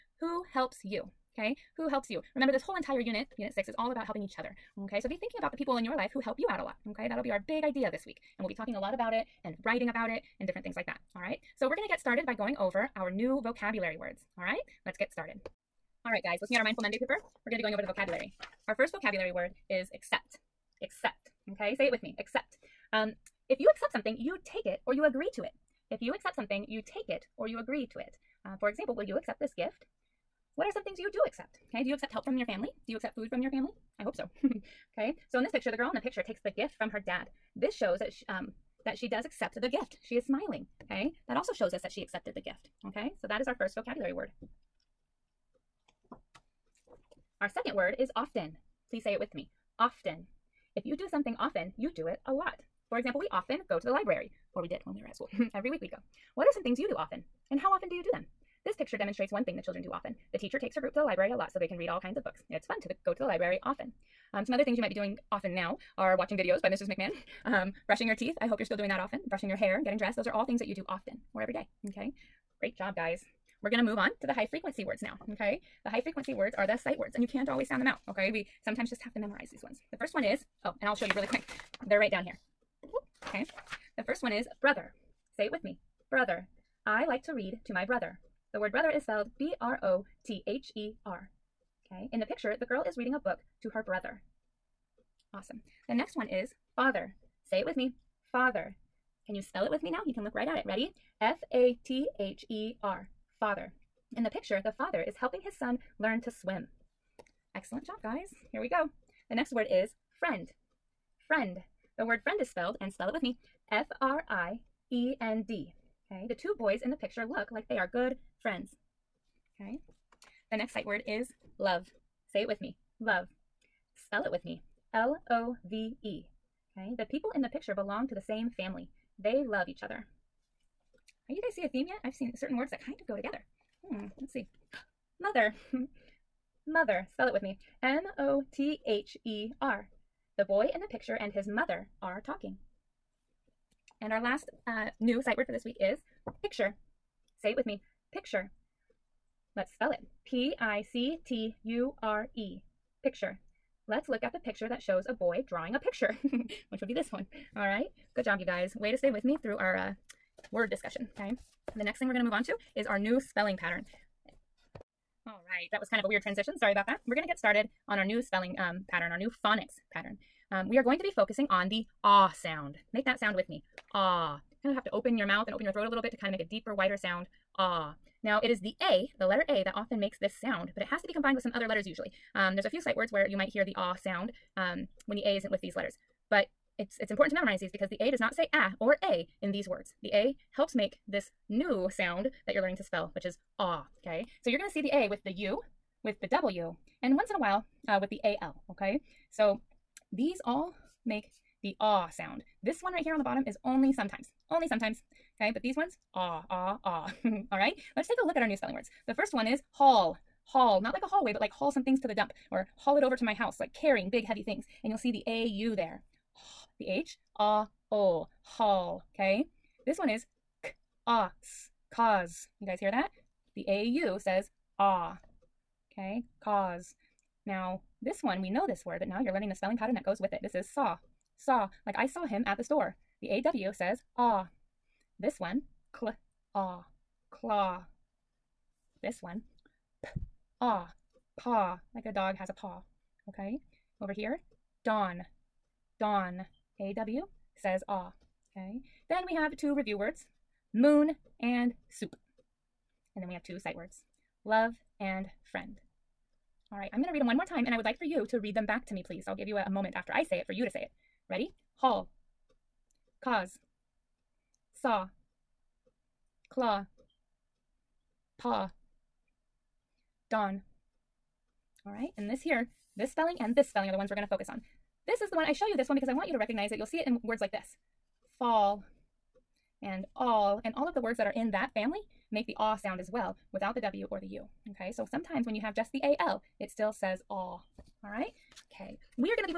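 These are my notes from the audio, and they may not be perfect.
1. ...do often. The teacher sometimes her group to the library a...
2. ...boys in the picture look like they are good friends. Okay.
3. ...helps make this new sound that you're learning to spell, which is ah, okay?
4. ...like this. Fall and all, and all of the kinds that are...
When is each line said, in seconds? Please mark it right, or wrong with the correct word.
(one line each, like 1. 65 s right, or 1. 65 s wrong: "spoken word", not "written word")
1. 59 s wrong: "takes", not "sometimes"
2. 116 s right
3. 190 s right
4. 277 s wrong: "words", not "kinds".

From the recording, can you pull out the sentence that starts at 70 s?
Those are all things that you do often.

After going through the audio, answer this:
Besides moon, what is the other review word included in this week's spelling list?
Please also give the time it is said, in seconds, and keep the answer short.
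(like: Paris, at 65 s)
soup, at 251 s.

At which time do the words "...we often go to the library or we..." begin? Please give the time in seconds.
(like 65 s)
53 s.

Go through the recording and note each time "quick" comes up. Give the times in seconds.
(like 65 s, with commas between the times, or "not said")
81 s.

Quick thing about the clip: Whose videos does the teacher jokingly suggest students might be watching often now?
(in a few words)
Mrs. McMahon.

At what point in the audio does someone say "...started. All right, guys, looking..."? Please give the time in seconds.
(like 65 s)
15 s.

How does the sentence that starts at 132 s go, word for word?
I've seen certain words that kind of go together.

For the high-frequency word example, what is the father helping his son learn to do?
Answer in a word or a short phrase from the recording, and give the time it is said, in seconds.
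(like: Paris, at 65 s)
swim, at 106 s.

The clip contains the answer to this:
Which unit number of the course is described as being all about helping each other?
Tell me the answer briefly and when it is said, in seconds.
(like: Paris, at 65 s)
6, at 3 s.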